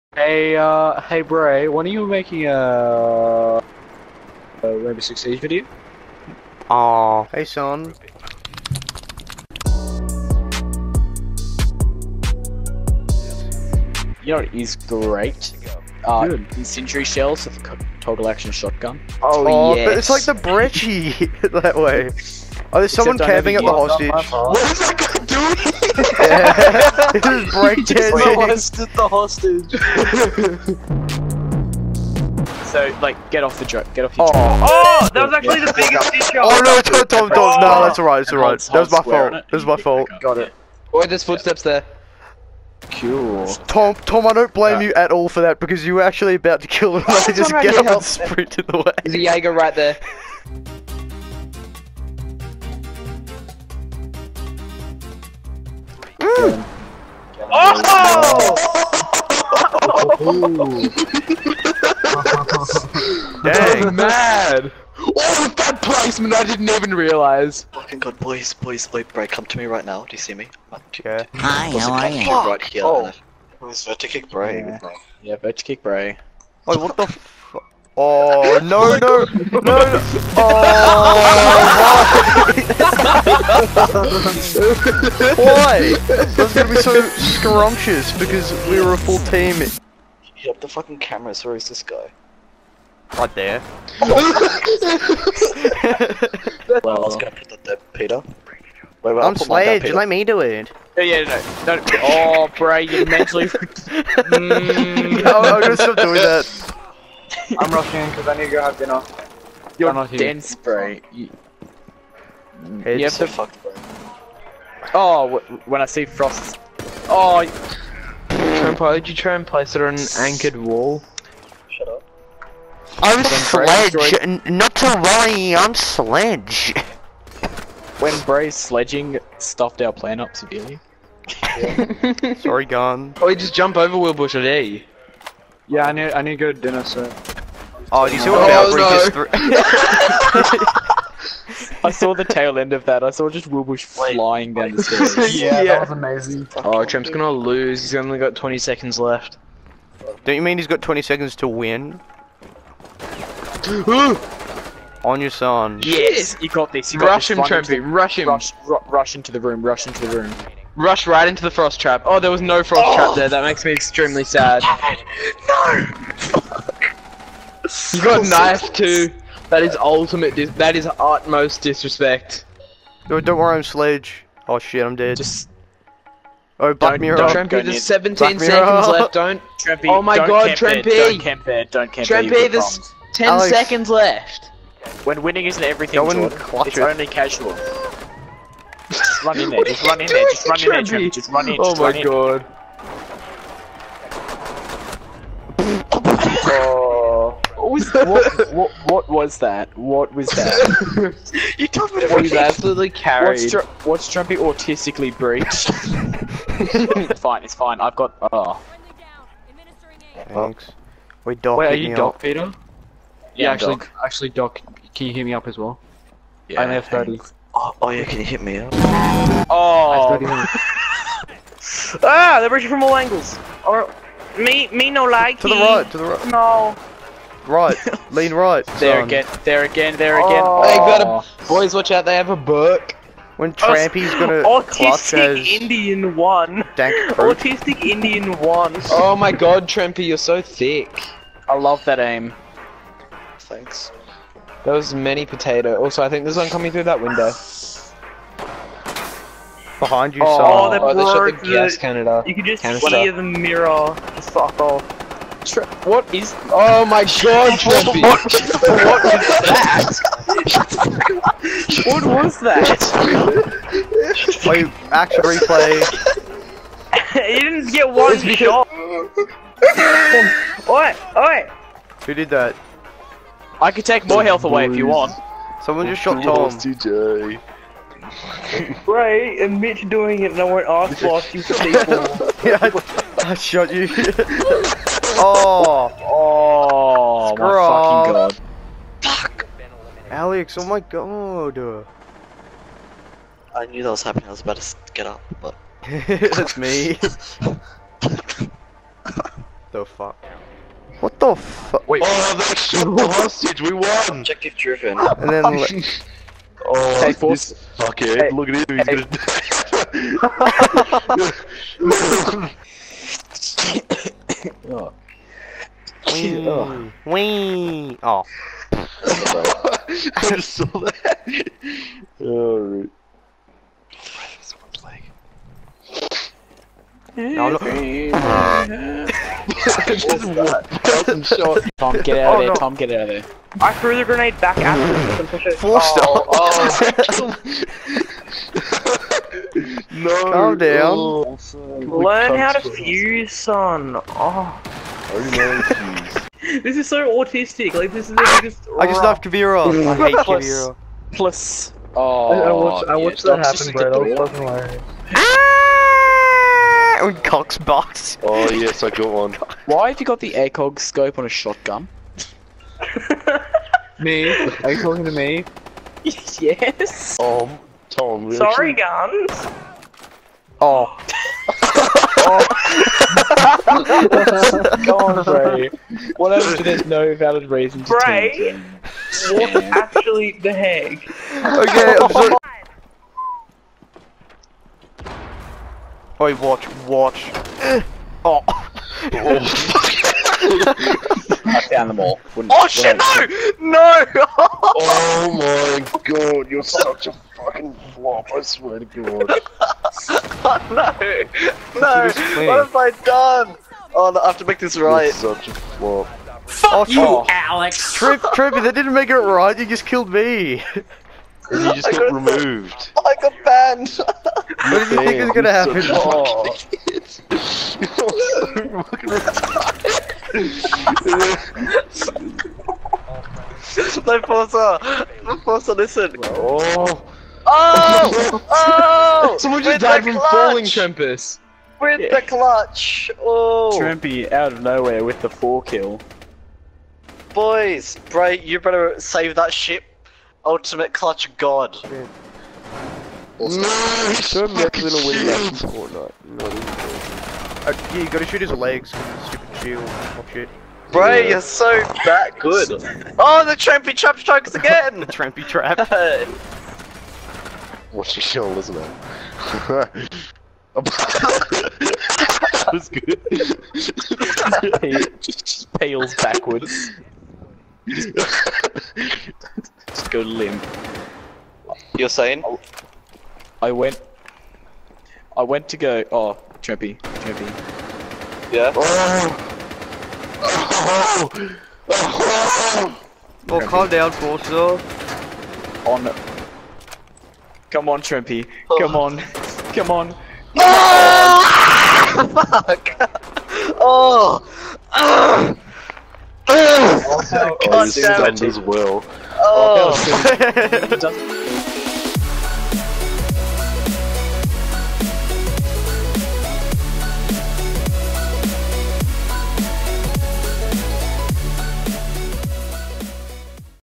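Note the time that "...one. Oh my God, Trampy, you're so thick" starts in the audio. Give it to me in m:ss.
3:58.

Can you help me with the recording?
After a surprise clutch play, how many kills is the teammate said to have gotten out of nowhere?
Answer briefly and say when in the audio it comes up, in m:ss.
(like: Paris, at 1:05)
4, at 7:15.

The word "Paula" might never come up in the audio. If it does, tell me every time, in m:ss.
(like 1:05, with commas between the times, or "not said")
not said.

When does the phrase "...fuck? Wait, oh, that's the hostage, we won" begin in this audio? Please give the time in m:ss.
5:01.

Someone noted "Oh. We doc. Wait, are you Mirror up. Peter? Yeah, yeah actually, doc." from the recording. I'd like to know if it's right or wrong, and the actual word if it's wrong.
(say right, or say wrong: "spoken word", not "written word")
wrong: "Doc", not "Mirror".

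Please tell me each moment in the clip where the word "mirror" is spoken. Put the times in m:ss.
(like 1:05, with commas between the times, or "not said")
2:57, 4:13.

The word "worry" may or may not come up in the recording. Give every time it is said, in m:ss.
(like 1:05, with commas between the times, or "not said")
2:05, 2:53.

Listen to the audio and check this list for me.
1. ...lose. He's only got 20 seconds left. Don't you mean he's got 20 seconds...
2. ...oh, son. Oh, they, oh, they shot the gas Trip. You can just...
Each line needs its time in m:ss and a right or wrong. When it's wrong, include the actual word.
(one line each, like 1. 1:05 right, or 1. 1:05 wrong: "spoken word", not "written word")
1. 2:27 right
2. 4:10 wrong: "Canada", not "Trip".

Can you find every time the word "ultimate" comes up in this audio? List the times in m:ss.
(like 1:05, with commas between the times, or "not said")
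2:49, 7:20.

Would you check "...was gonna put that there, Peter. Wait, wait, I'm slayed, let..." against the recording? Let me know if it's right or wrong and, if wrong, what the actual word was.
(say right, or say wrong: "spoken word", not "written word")
right.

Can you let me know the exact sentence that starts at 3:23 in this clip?
What's, Dr- what's Drumpy autistically breached?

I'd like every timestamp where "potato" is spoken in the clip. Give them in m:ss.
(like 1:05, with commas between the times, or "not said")
4:05.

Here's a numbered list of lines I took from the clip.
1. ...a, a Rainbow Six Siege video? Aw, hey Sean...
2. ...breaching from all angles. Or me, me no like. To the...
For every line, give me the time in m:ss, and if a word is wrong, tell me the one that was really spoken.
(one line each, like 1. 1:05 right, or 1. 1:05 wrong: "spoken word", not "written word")
1. 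0:02 right
2. 3:42 right.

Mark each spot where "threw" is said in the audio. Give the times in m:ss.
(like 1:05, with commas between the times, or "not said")
2:19, 5:33.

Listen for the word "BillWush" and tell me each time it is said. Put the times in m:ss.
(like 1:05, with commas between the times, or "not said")
2:13, 2:23.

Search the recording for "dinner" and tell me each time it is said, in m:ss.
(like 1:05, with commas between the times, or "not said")
1:48, 2:16.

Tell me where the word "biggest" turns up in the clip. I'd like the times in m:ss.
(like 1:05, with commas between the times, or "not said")
0:35, 5:48.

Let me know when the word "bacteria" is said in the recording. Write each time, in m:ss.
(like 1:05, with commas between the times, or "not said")
not said.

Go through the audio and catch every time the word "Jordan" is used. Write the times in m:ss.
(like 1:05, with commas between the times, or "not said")
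3:05.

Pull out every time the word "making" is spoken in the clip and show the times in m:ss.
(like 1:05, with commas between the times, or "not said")
0:02.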